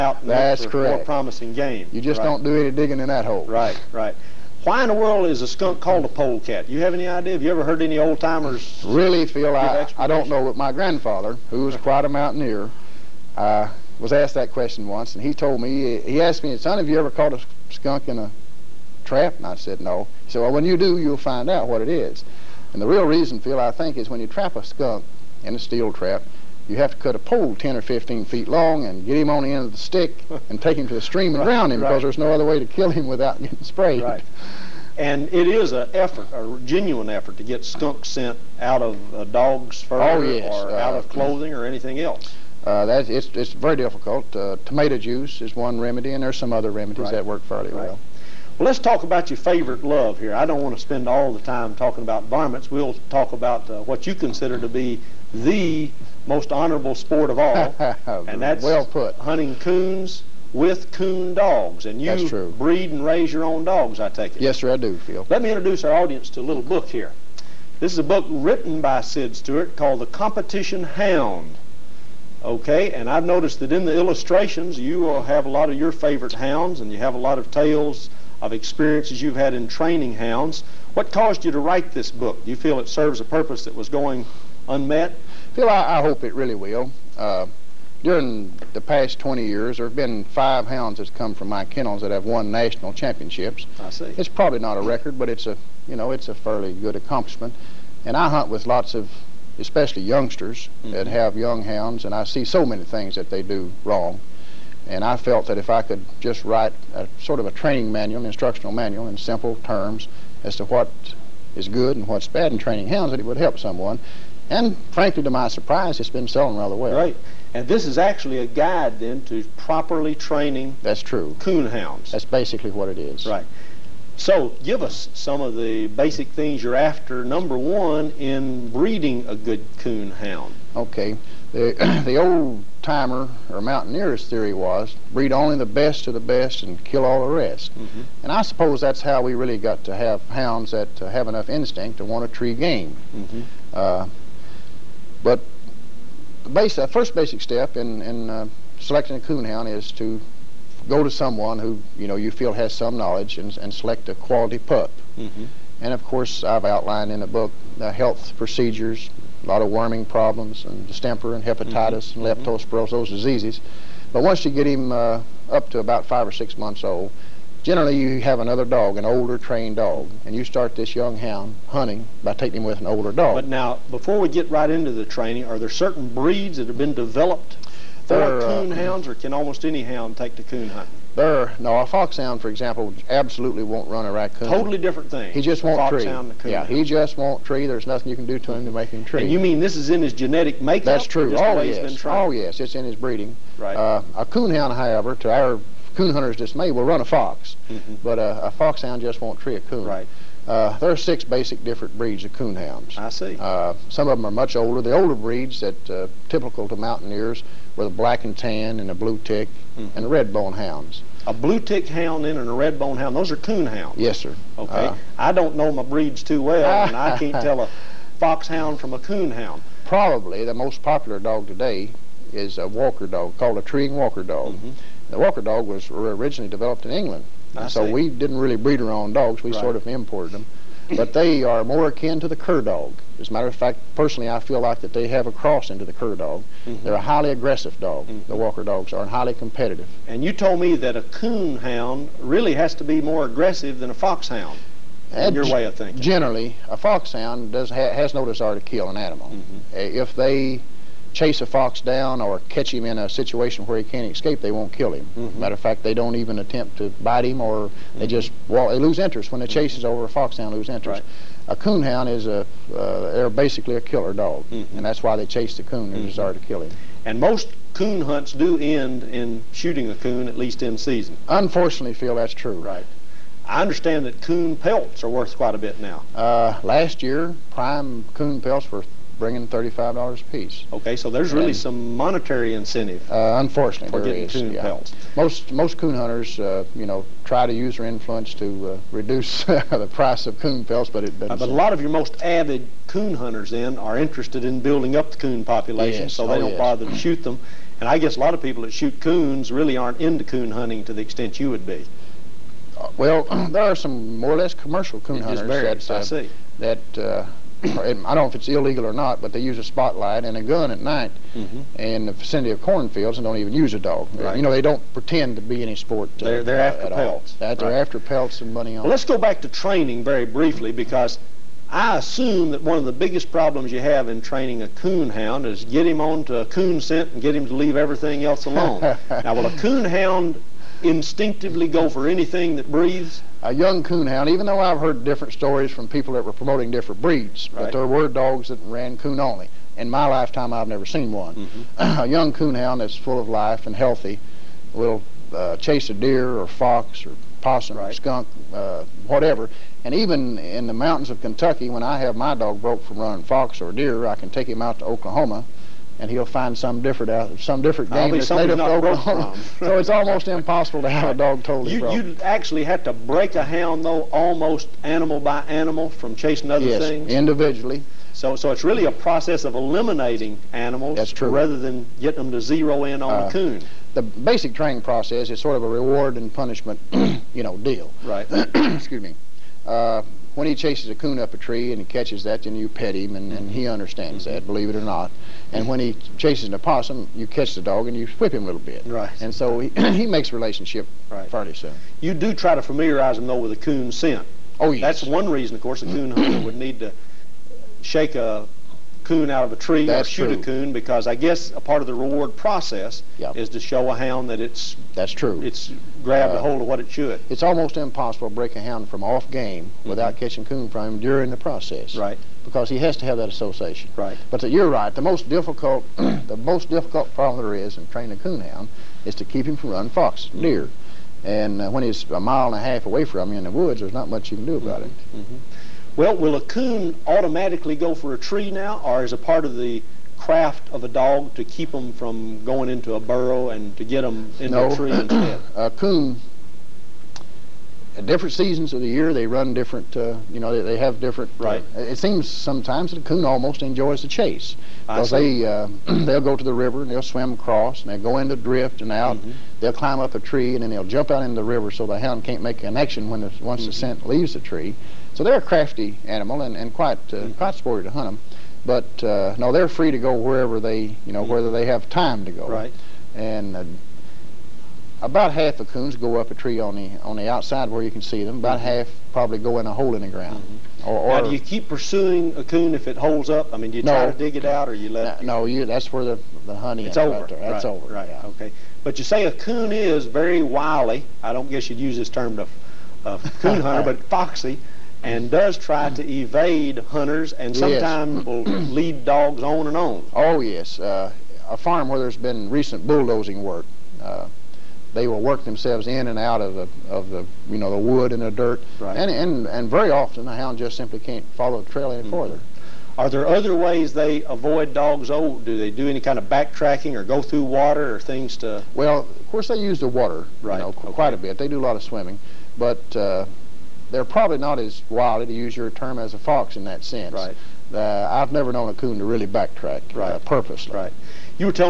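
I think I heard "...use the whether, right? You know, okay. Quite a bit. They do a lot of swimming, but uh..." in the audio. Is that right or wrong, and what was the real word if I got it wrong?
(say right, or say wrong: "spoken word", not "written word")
wrong: "water", not "whether".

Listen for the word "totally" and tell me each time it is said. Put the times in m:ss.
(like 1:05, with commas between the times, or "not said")
3:04, 6:01.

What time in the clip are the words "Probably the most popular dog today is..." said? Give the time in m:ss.
3:39.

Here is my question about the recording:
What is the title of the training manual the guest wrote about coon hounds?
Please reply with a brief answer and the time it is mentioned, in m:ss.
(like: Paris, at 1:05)
The Competition Hound, at 1:09.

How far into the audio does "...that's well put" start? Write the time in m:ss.
0:58.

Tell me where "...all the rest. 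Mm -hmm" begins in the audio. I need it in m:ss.
2:17.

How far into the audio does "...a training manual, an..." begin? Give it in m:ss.
1:47.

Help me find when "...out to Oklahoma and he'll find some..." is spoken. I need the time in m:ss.
5:54.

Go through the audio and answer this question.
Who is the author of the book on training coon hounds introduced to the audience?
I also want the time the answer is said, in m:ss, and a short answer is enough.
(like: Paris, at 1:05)
Sid Stewart, at 1:09.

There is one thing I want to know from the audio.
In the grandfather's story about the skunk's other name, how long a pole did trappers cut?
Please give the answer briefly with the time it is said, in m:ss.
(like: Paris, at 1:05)
10 or 15 feet, at 0:27.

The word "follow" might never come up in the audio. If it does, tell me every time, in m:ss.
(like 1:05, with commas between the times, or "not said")
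8:21.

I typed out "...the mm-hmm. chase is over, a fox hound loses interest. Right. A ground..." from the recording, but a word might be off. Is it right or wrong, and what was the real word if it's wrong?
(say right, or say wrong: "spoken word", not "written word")
wrong: "coonhound", not "ground".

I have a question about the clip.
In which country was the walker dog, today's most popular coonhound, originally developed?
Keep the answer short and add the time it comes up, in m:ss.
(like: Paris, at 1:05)
England, at 3:46.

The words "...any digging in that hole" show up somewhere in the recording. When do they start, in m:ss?
0:02.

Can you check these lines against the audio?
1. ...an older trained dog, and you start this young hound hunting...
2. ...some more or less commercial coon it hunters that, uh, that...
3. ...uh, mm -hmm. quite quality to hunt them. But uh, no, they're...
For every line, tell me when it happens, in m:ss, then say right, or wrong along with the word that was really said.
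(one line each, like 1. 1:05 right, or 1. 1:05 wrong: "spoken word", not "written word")
1. 2:48 right
2. 5:03 right
3. 7:37 wrong: "sporty", not "quality".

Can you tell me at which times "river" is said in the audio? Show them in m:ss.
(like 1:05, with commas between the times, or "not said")
7:26, 7:31.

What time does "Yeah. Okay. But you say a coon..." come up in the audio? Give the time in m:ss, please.
7:58.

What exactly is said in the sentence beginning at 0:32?
other way to kill him without getting sprayed.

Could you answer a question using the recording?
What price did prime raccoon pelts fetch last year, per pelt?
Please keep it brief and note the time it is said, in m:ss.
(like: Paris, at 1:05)
$35, at 4:39.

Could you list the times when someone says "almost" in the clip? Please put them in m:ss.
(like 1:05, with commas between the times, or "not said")
2:59, 5:59, 6:04, 6:47, 7:23.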